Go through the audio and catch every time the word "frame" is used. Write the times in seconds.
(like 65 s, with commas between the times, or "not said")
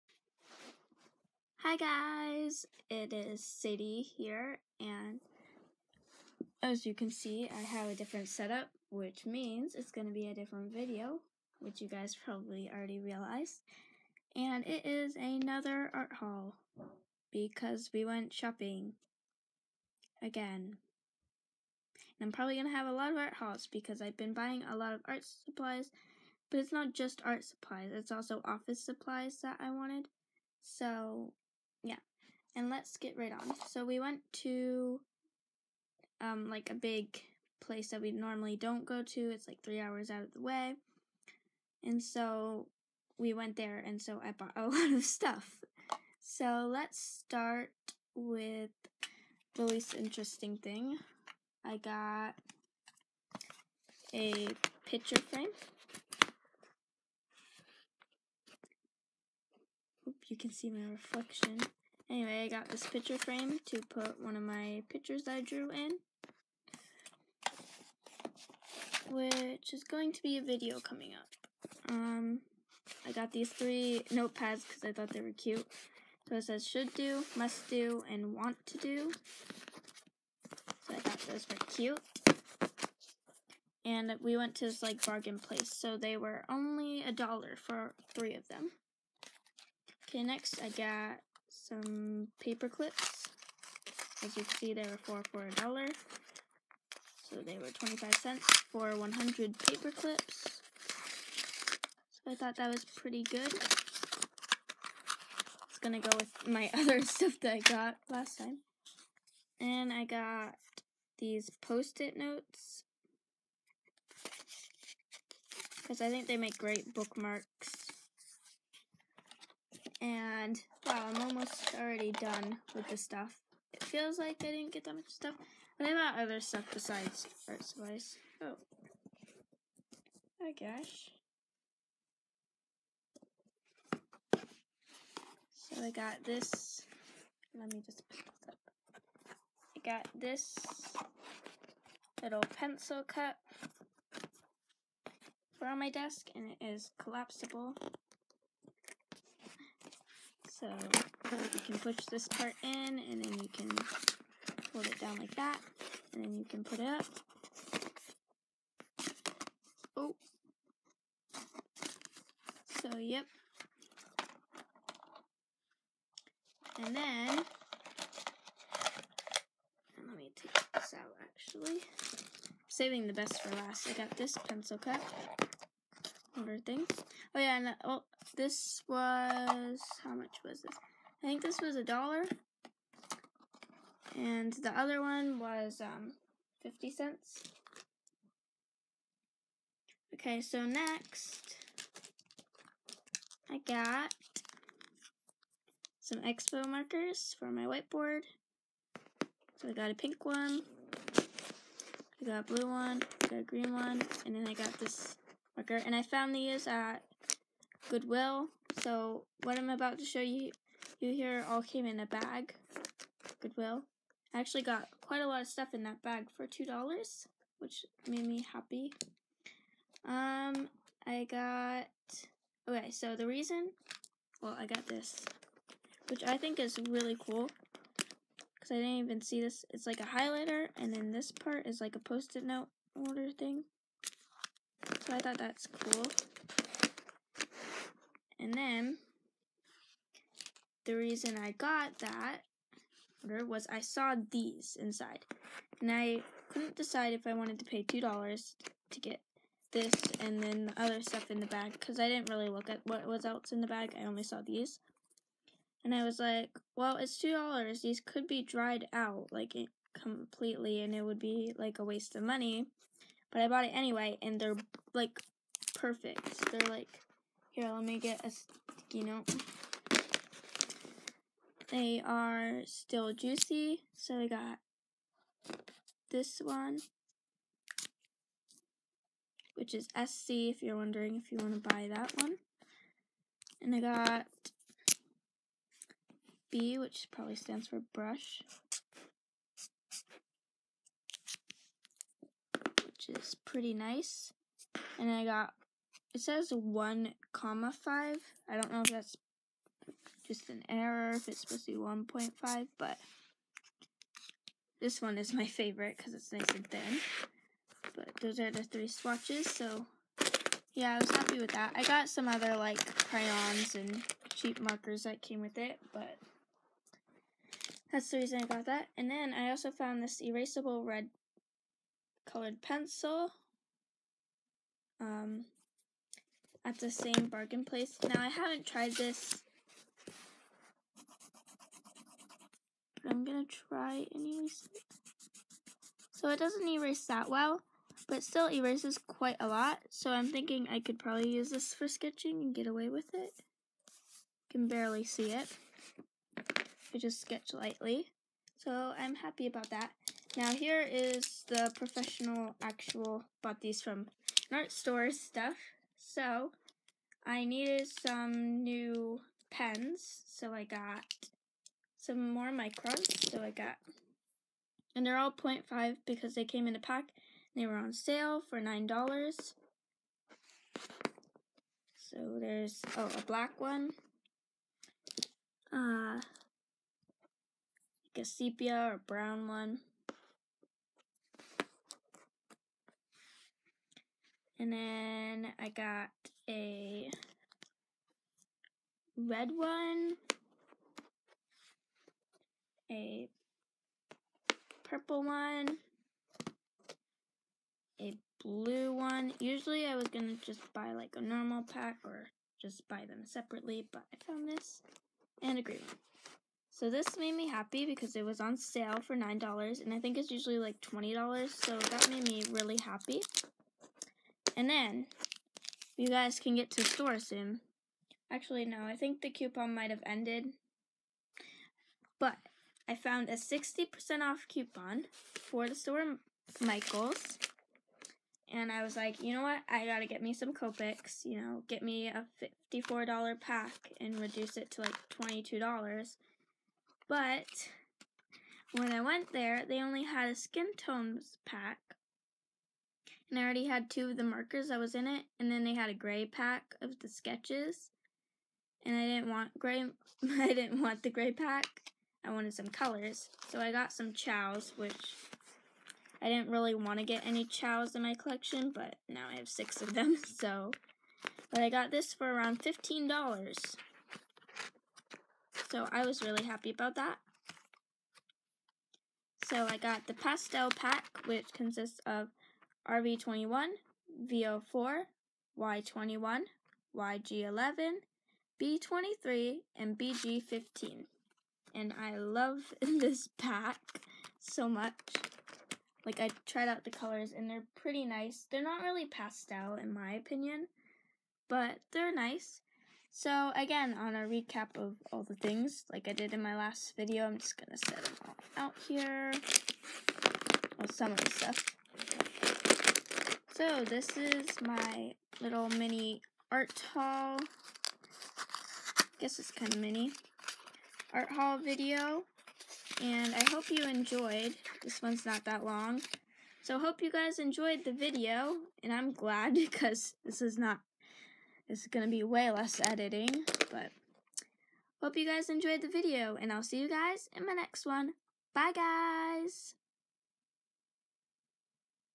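55 s, 63 s.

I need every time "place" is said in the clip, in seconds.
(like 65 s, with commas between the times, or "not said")
37 s, 85 s, 327 s.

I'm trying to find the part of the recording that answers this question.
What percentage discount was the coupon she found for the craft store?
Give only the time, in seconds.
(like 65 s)
423 s.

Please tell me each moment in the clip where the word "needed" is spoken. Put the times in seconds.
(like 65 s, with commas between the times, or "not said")
357 s.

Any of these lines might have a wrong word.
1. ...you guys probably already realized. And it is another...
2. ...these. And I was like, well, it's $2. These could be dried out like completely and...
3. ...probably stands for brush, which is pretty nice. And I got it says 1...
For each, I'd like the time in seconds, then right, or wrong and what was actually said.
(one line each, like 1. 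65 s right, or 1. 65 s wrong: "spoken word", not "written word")
1. 11 s right
2. 254 s right
3. 287 s right.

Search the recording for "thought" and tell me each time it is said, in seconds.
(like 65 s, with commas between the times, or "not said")
74 s, 80 s, 102 s, 235 s.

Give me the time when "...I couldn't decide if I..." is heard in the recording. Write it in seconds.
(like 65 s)
245 s.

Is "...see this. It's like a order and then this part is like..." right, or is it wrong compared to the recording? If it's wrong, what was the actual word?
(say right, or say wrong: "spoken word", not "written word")
wrong: "highlighter", not "order".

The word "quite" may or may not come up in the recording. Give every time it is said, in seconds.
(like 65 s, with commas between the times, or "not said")
215 s, 338 s.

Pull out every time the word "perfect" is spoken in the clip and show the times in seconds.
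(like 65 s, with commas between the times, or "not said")
265 s.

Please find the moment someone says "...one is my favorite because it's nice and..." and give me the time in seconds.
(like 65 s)
305 s.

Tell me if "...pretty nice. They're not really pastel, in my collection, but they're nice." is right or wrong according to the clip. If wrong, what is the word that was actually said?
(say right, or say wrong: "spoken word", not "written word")
wrong: "opinion", not "collection".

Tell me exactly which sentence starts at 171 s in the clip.
I'm saving the best for last.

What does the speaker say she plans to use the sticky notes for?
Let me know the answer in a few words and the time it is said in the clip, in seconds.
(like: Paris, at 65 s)
bookmarks, at 116 s.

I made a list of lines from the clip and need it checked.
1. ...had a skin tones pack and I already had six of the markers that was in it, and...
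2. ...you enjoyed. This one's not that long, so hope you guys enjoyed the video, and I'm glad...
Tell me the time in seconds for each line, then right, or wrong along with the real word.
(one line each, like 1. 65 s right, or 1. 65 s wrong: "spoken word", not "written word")
1. 440 s wrong: "two", not "six"
2. 513 s right.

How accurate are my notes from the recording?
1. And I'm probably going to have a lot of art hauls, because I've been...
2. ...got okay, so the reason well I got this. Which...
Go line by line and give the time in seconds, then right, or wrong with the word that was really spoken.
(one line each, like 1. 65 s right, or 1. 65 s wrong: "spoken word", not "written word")
1. 22 s right
2. 221 s right.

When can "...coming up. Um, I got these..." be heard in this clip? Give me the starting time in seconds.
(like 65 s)
70 s.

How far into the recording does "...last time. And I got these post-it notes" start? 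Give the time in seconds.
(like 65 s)
108 s.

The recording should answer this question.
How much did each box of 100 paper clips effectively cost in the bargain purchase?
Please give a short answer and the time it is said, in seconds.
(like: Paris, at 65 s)
25 cents, at 97 s.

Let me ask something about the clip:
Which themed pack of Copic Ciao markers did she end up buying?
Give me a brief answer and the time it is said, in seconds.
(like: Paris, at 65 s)
pastel pack, at 470 s.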